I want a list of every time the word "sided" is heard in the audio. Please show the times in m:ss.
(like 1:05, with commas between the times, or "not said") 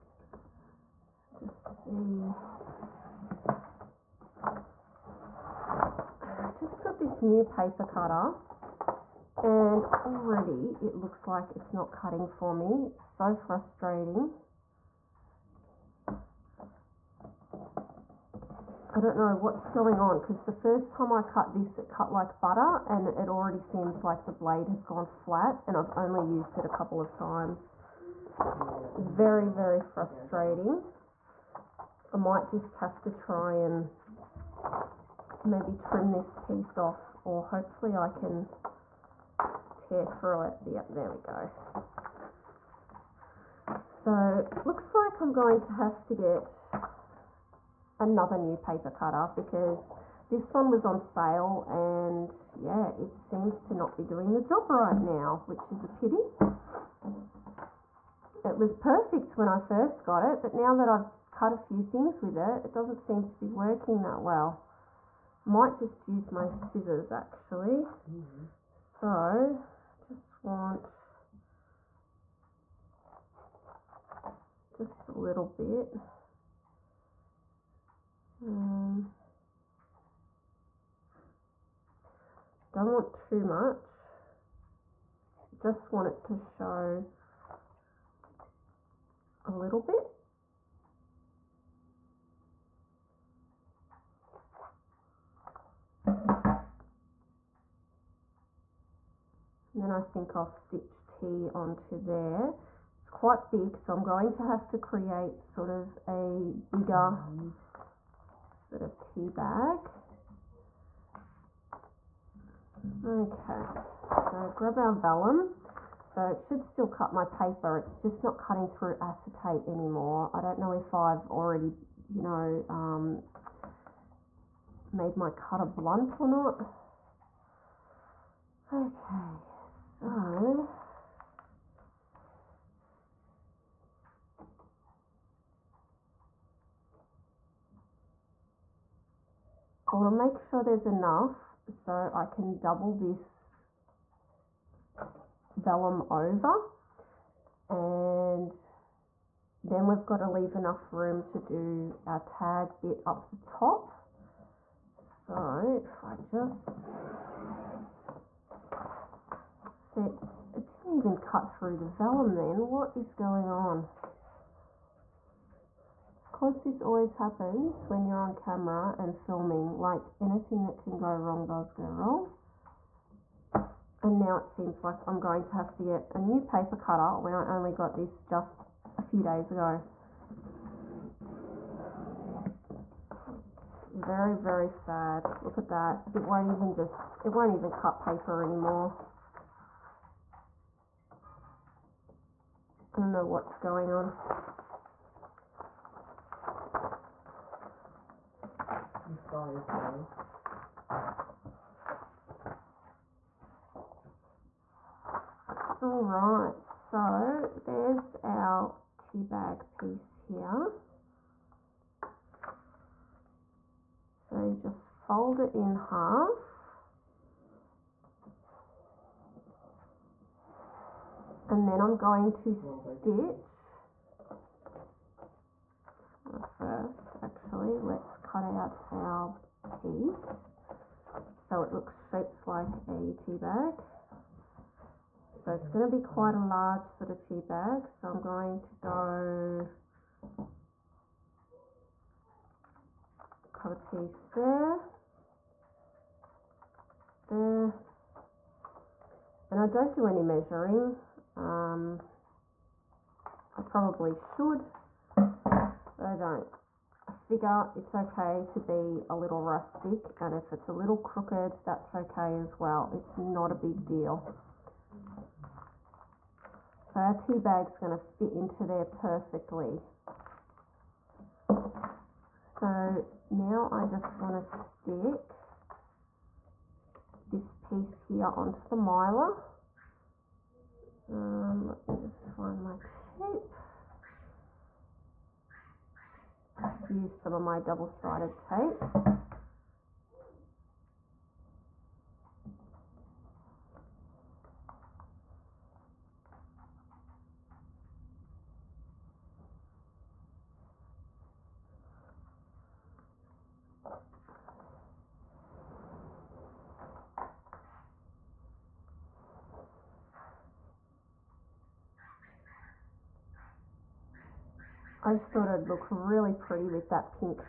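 4:47.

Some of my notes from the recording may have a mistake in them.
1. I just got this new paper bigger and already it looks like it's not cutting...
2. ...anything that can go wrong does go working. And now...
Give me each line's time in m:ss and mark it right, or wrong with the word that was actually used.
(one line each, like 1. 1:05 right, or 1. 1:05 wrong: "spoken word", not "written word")
1. 0:04 wrong: "cutter", not "bigger"
2. 2:50 wrong: "wrong", not "working".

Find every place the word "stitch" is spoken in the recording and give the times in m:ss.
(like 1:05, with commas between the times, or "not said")
1:40, 3:42.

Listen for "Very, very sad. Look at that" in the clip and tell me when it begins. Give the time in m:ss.
3:03.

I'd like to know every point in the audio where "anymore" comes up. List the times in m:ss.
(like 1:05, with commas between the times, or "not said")
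1:59, 3:08.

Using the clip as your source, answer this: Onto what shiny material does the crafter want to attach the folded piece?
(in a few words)
mylar.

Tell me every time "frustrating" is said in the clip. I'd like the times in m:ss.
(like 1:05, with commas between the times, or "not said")
0:13, 0:29.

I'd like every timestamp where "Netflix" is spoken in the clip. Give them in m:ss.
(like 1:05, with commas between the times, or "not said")
not said.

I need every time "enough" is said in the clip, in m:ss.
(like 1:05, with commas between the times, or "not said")
2:20, 2:30.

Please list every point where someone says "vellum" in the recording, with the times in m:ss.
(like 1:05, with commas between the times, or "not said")
1:54, 2:25, 2:41.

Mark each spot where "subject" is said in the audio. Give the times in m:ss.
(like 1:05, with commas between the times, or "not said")
not said.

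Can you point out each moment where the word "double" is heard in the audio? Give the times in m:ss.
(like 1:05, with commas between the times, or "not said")
2:22, 4:47.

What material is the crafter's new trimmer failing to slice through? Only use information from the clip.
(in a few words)
acetate.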